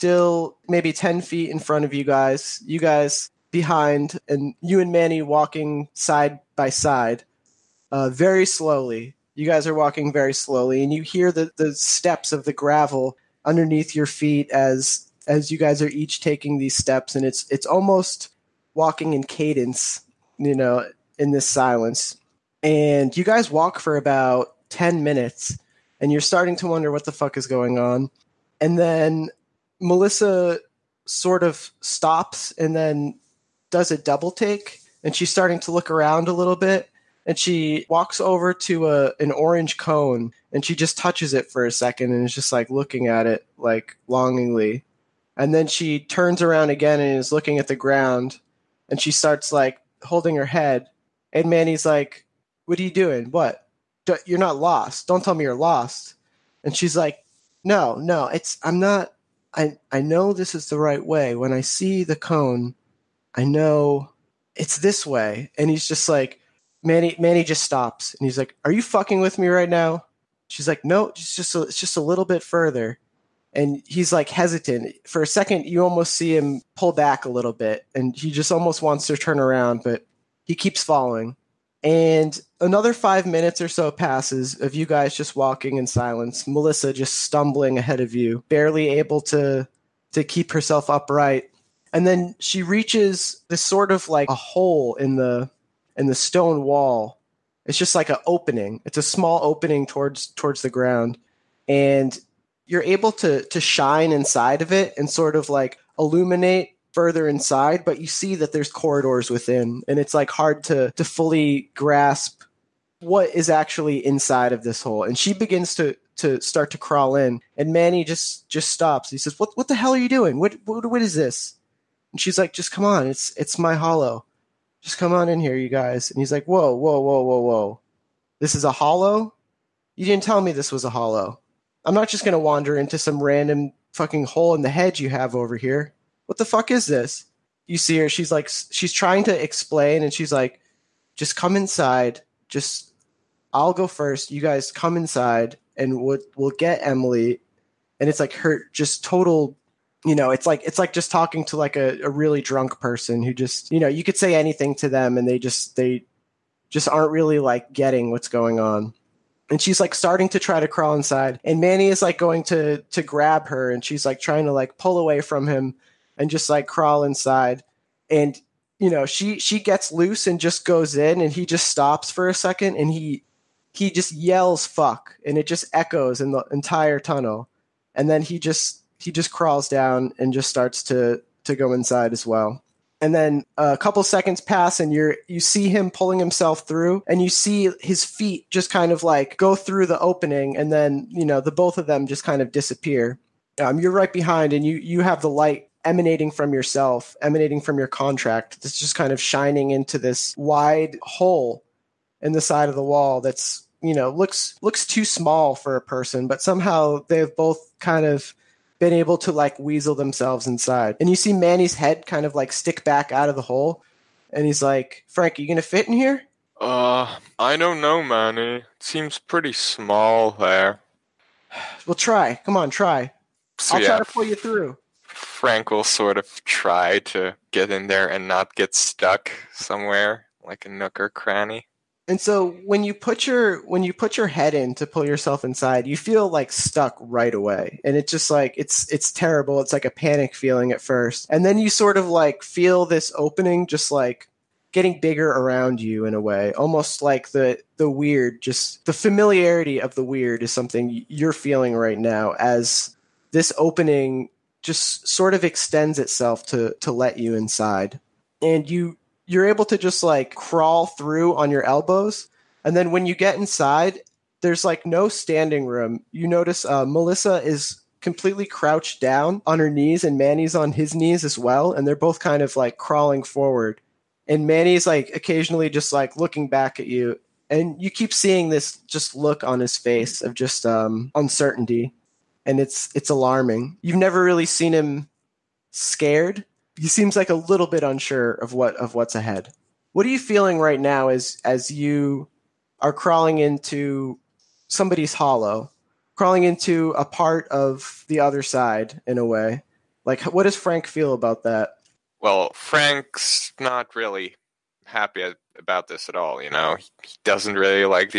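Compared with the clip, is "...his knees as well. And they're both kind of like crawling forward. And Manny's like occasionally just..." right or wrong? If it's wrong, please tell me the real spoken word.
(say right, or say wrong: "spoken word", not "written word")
right.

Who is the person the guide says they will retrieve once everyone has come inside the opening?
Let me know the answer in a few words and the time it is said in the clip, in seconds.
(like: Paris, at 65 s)
Emily, at 146 s.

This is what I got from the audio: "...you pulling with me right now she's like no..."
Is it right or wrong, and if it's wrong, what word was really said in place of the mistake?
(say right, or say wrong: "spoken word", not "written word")
wrong: "fucking", not "pulling".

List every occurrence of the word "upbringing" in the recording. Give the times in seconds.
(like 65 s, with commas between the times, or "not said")
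not said.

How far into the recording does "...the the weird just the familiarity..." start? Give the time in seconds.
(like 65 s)
247 s.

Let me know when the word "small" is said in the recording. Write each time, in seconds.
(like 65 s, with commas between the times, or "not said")
99 s, 205 s, 219 s.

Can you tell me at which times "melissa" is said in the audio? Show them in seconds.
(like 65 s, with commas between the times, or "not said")
29 s, 86 s, 266 s.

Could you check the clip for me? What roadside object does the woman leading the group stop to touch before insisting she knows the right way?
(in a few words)
An orange cone.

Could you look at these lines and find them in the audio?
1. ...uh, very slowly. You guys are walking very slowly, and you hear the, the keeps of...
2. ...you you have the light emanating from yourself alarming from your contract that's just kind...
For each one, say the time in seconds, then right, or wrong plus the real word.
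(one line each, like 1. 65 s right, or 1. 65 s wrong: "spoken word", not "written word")
1. 7 s wrong: "steps", not "keeps"
2. 194 s wrong: "emanating", not "alarming".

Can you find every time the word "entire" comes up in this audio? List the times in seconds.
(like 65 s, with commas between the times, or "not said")
176 s.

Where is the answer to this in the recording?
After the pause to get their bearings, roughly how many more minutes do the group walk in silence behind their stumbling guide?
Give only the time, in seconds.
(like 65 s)
82 s.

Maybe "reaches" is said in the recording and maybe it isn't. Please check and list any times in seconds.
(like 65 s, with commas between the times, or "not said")
92 s.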